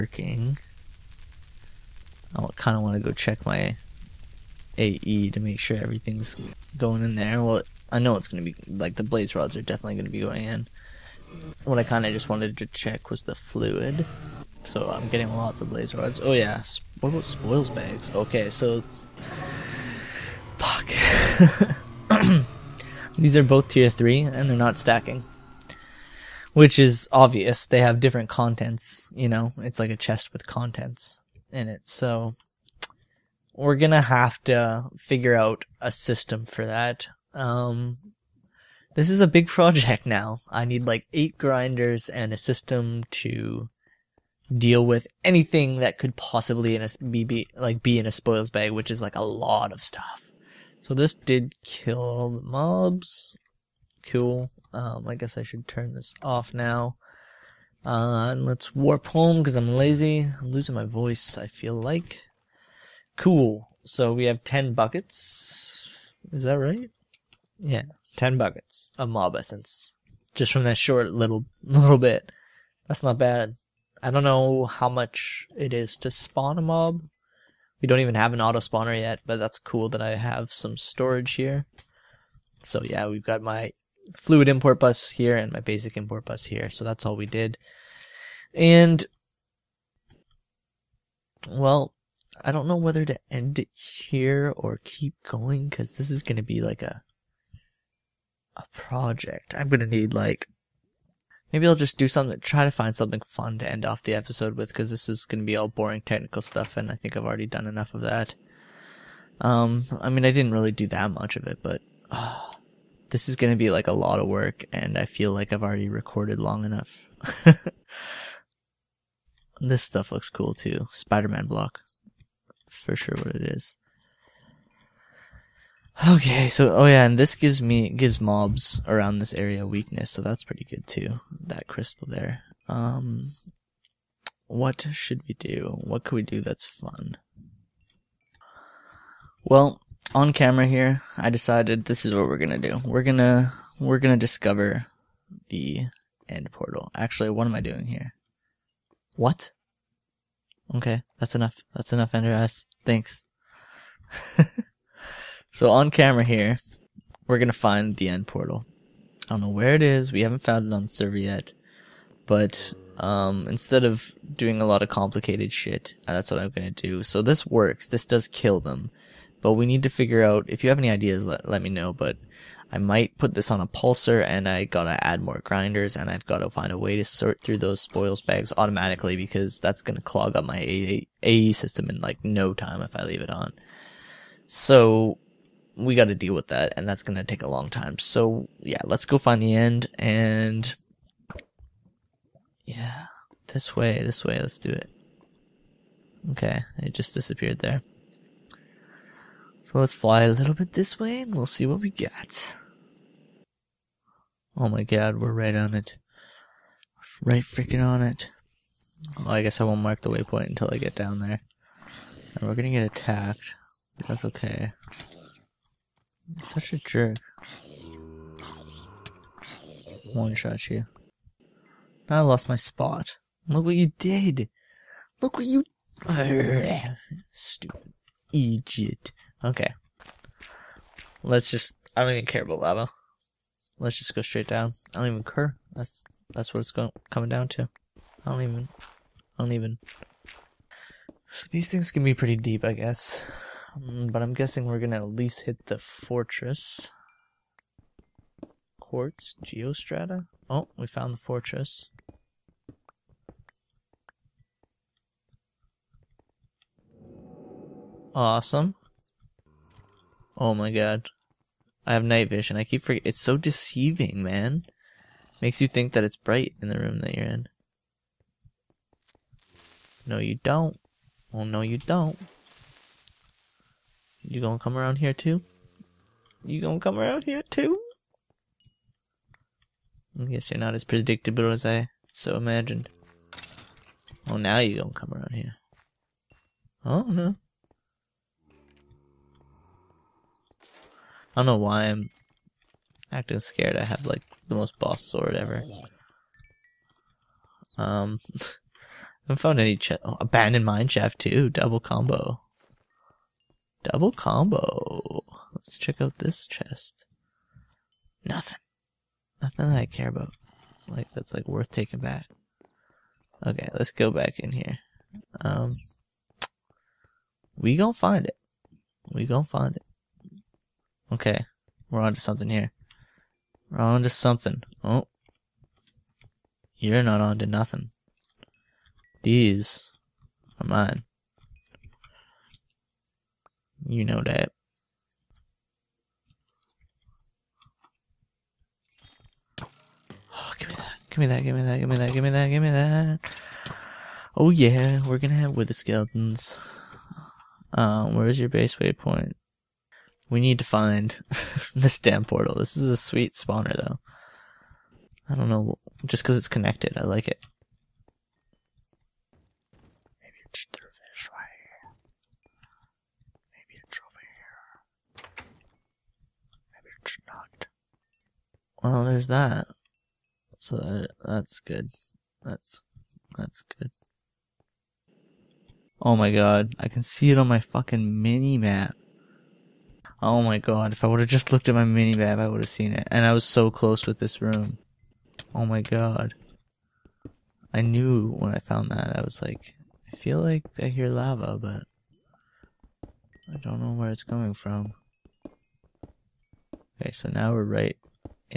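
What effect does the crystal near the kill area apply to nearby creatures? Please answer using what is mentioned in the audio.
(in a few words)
weakness.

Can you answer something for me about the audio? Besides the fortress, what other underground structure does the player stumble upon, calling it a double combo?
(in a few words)
abandoned mineshaft.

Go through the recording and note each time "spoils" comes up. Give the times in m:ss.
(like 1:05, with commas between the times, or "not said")
0:17, 0:48, 2:57.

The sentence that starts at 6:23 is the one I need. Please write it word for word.
And I was so close with this room.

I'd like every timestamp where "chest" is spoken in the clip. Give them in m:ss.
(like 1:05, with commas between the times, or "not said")
0:29, 4:59, 5:06.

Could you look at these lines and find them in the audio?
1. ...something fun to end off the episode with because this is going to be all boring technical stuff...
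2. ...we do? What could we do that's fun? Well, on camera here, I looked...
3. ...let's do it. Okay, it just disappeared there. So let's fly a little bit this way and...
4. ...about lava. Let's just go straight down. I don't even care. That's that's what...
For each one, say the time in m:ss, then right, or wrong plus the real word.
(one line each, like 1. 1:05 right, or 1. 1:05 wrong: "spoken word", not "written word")
1. 1:42 right
2. 2:15 wrong: "decided", not "looked"
3. 3:14 right
4. 3:52 right.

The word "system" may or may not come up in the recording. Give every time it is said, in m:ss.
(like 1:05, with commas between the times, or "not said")
0:35, 0:42, 3:01.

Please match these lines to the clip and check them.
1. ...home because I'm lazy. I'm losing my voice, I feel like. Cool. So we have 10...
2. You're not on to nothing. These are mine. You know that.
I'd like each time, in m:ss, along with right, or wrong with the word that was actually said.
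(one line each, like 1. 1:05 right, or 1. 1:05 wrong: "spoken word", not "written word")
1. 0:59 right
2. 5:26 right.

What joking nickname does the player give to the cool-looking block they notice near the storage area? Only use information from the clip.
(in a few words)
Spider-Man block.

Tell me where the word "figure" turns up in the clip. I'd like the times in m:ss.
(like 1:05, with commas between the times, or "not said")
0:34, 2:49.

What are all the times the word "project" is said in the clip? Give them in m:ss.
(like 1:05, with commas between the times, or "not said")
0:39, 1:38.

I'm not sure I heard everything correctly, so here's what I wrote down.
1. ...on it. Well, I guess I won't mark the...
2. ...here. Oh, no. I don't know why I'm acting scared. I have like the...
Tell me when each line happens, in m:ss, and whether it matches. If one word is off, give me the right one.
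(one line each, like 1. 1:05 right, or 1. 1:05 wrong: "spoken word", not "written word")
1. 3:27 right
2. 4:45 right.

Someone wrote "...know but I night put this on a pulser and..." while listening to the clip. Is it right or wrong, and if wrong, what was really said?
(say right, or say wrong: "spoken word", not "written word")
wrong: "might", not "night".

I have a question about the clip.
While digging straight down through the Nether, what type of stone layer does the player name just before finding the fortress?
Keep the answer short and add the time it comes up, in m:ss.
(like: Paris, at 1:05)
Quartz geostrata, at 4:08.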